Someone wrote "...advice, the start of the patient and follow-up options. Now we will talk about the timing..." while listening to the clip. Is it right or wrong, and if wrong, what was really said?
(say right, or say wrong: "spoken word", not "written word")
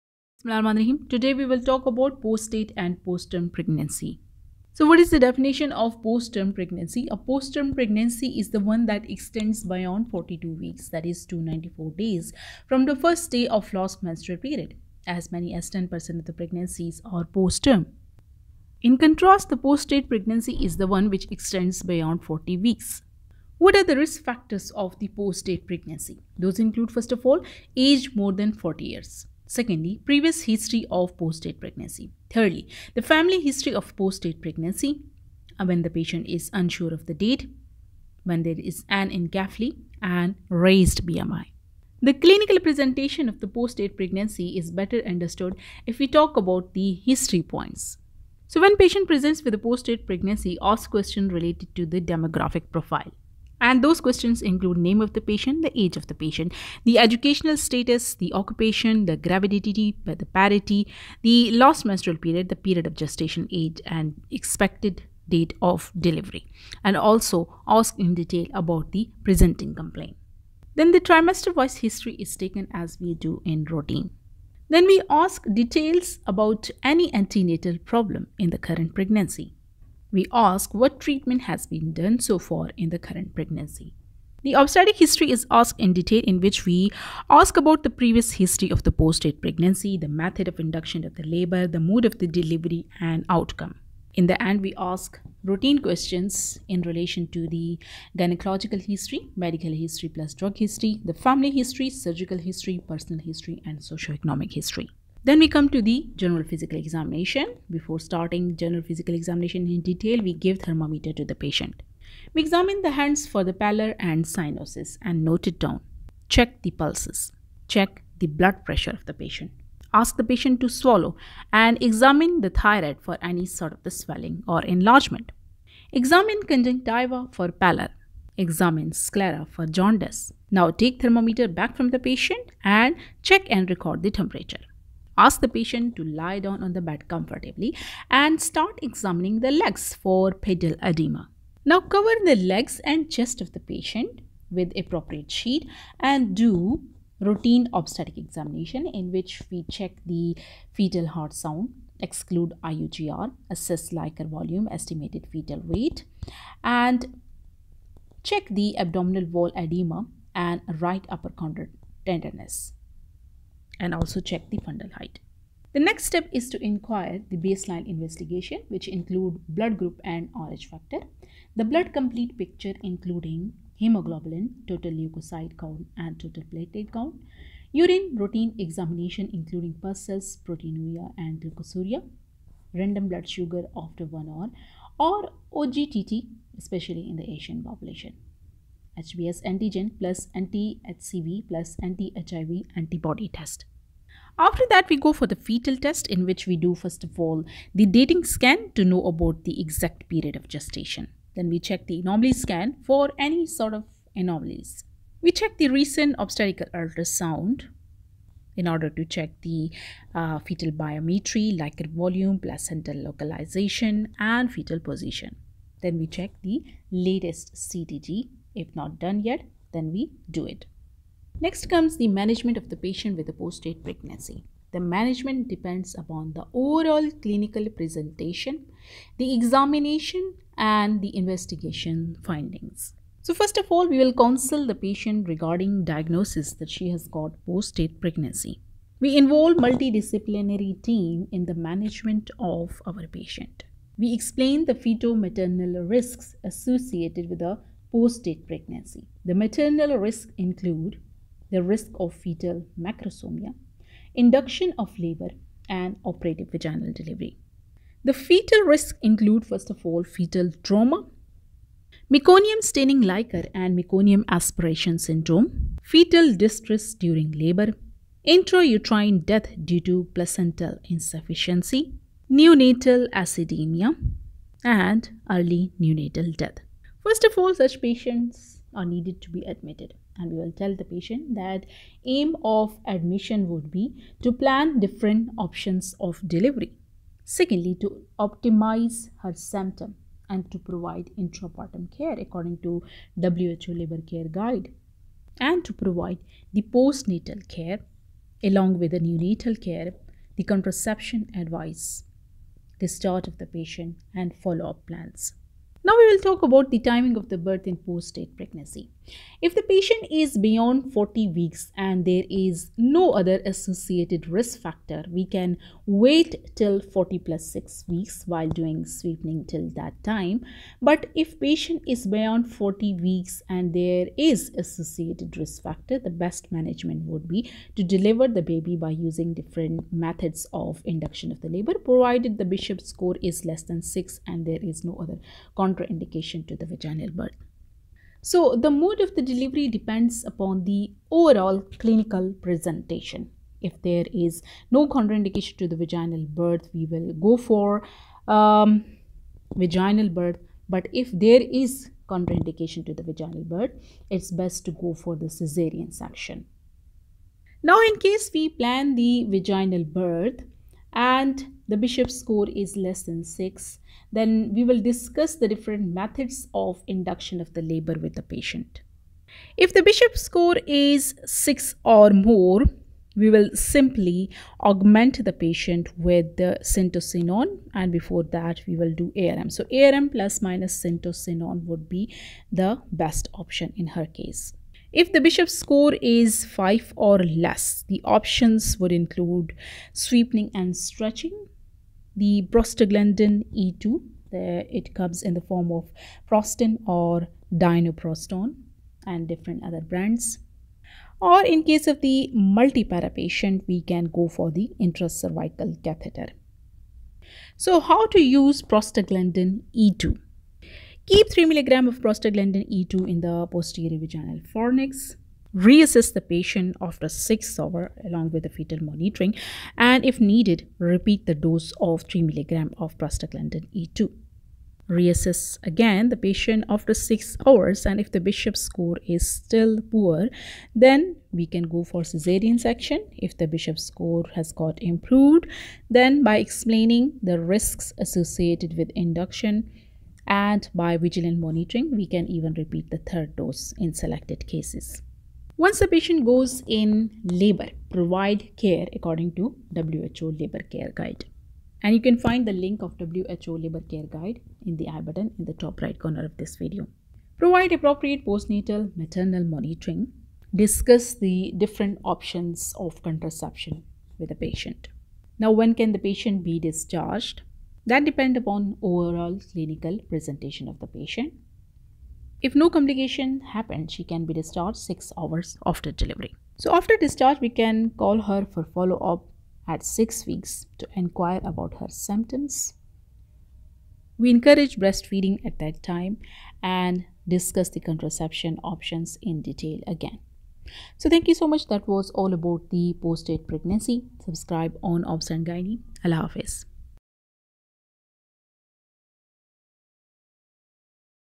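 wrong: "plans", not "options".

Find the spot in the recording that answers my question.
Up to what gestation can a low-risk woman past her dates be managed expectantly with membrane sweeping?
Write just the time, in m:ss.
5:16.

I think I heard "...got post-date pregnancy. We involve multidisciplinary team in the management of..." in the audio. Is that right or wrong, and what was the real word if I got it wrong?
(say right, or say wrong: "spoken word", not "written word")
right.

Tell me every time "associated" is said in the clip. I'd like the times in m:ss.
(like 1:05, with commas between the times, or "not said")
4:06, 5:13, 5:24, 7:17.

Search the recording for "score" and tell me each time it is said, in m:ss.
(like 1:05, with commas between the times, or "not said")
5:32, 6:02, 6:10, 6:25, 7:08, 7:13.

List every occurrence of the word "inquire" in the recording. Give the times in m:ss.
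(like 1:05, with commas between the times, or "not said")
2:46, 8:00.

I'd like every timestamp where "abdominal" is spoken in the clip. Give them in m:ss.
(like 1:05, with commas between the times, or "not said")
2:38.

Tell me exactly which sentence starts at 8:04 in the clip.
We encourage breastfeeding at that time and discuss the contraception options in detail again.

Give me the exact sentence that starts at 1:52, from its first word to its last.
We examine the hands for the pallor and cyanosis and note it down.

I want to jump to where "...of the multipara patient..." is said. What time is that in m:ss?
6:41.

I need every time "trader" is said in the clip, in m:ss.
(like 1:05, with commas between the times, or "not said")
not said.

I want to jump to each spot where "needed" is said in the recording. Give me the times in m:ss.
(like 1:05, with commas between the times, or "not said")
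4:38, 7:00.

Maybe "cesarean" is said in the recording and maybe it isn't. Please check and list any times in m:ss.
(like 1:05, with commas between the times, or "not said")
5:55, 7:12.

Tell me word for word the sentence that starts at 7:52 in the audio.
If no complication happened, she can be discharged 6 hours after delivery.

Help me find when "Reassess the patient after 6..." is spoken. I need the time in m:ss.
6:55.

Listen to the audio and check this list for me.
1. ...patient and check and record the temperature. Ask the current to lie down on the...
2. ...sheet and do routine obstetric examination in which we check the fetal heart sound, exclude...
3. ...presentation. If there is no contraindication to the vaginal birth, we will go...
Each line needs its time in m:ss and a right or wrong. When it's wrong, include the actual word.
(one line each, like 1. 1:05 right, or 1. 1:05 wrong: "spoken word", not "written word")
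1. 2:11 wrong: "patient", not "current"
2. 2:25 right
3. 5:42 right.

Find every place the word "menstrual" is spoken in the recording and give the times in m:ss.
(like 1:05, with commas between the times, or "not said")
0:14, 1:01.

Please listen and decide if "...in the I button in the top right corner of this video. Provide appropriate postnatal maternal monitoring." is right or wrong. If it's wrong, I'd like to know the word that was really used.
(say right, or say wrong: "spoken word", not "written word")
right.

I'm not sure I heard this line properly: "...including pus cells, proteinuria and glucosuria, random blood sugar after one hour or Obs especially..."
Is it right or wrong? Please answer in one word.
wrong.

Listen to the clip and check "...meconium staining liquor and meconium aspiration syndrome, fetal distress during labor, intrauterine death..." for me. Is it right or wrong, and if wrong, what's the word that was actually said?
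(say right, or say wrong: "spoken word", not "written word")
right.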